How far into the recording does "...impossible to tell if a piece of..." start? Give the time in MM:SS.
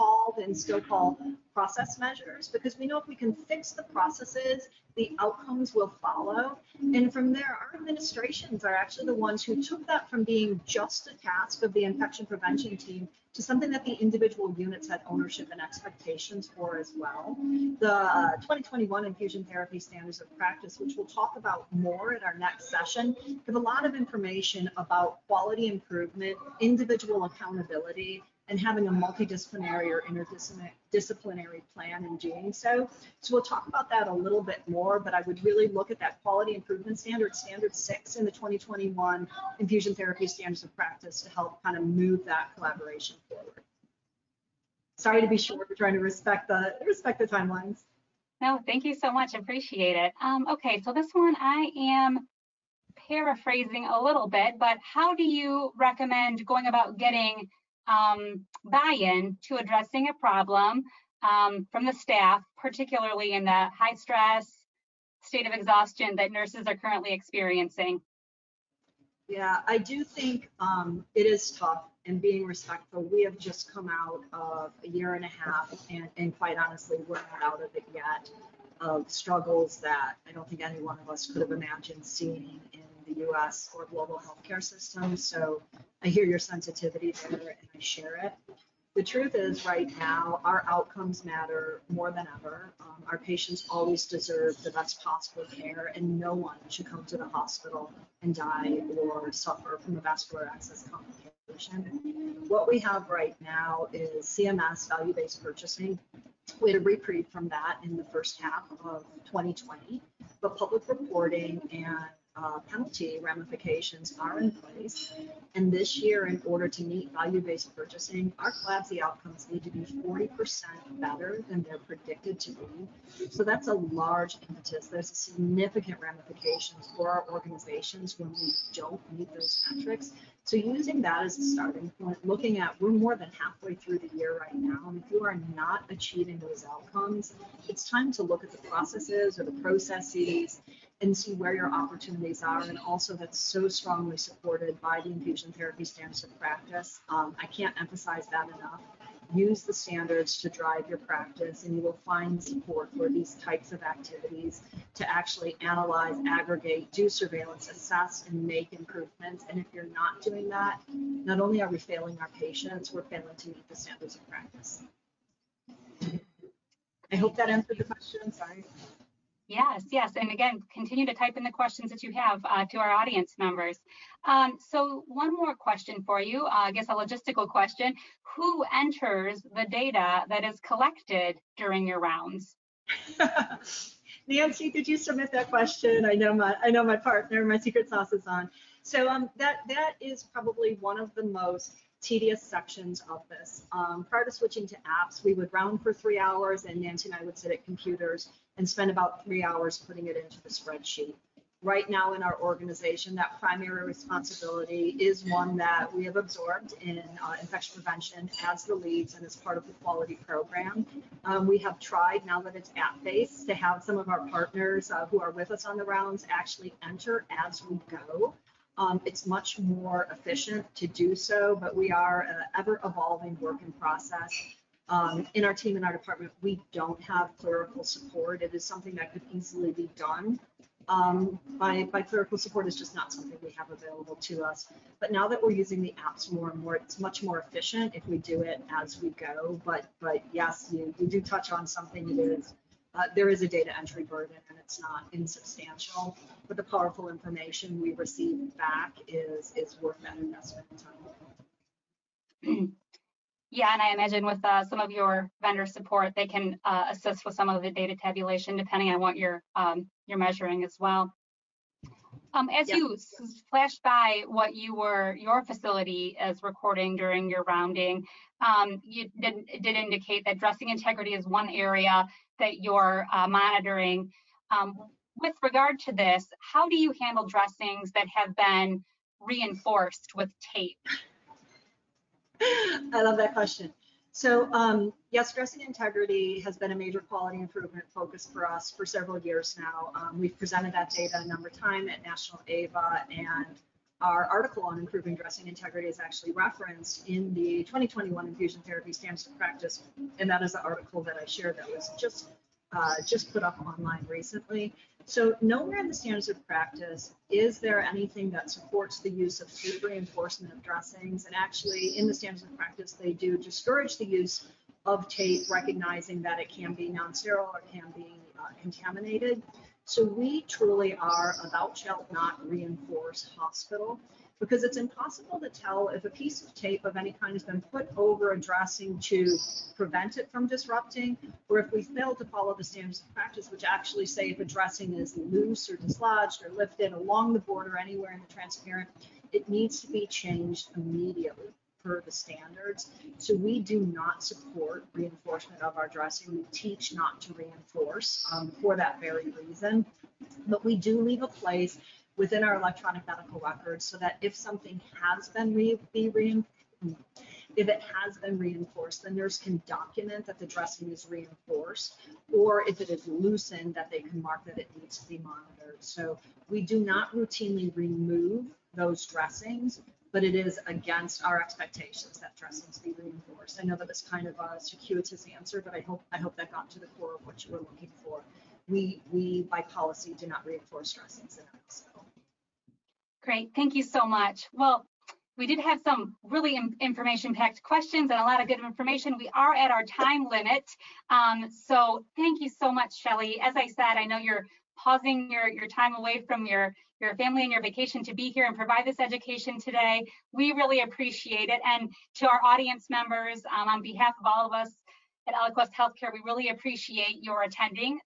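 05:24.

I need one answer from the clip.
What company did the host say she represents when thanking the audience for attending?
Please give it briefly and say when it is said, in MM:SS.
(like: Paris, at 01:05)
Eloquest Healthcare, at 06:45.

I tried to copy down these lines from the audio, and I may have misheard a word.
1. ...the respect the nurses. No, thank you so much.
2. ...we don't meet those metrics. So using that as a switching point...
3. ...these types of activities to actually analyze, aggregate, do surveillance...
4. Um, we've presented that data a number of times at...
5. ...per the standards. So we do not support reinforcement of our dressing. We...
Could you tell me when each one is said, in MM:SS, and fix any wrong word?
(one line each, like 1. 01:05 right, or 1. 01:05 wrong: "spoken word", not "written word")
1. 00:46 wrong: "timelines", not "nurses"
2. 02:08 wrong: "starting", not "switching"
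3. 02:33 right
4. 04:49 right
5. 05:41 right.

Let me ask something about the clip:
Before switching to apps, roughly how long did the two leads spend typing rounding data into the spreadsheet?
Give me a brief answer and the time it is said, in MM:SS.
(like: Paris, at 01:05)
about three hours, at 03:18.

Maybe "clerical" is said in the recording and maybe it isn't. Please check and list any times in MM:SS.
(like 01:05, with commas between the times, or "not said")
03:47, 03:52.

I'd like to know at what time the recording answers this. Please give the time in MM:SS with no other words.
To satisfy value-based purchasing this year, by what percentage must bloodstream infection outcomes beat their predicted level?
01:59.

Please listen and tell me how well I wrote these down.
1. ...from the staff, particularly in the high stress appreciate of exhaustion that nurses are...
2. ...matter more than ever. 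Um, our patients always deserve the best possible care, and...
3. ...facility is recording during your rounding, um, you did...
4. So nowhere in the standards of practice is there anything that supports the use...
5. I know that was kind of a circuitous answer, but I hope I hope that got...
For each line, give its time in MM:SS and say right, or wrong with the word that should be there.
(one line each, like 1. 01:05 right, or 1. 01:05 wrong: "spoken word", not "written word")
1. 01:01 wrong: "state", not "appreciate"
2. 01:31 right
3. 04:25 right
4. 05:05 right
5. 06:13 right.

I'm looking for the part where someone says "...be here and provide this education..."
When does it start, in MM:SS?
06:38.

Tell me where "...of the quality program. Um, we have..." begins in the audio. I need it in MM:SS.
03:29.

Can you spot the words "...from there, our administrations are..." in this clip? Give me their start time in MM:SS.
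00:07.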